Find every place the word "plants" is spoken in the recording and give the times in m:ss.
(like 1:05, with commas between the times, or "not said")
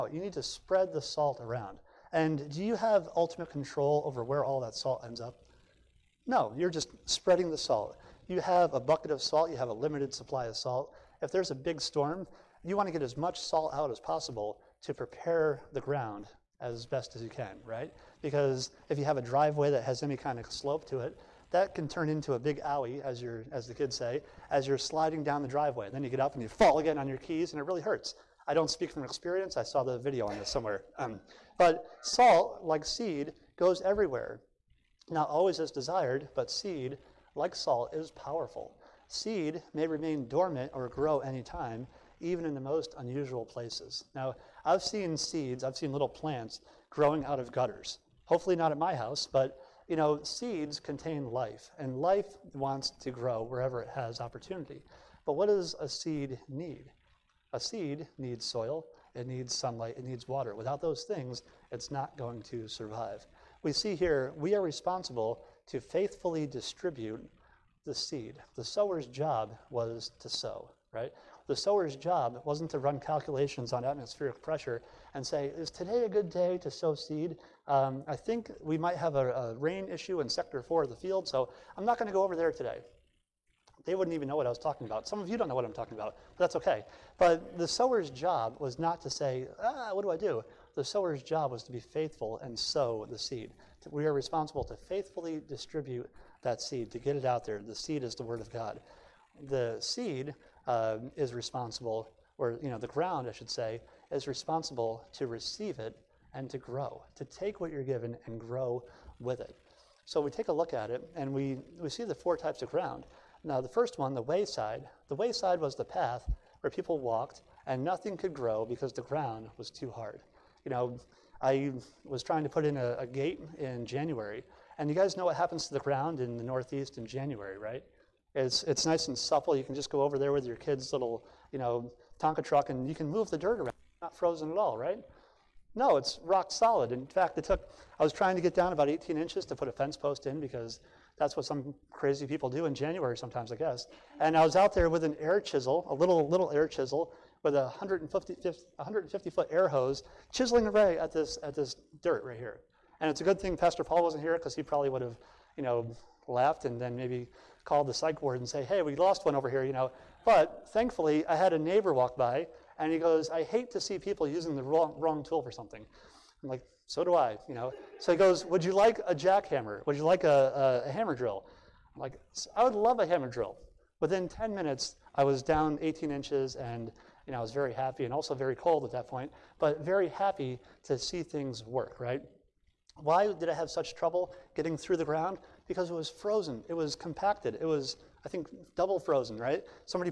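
0:46.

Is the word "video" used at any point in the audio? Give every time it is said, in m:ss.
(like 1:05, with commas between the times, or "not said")
0:29.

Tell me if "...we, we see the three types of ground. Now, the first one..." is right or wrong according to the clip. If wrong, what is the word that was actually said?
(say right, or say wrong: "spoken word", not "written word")
wrong: "four", not "three".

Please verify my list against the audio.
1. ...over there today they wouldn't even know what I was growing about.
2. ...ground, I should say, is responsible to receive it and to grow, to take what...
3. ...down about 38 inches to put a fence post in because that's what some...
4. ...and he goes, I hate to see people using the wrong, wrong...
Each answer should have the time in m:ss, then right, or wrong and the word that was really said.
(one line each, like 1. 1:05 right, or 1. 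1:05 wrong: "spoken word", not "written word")
1. 1:22 wrong: "talking", not "growing"
2. 1:42 right
3. 2:18 wrong: "18", not "38"
4. 2:42 right.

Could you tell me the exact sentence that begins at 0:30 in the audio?
Um, but salt, like seed, goes everywhere.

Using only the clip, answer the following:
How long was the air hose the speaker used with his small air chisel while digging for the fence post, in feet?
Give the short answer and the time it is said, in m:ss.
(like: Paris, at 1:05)
150, at 2:27.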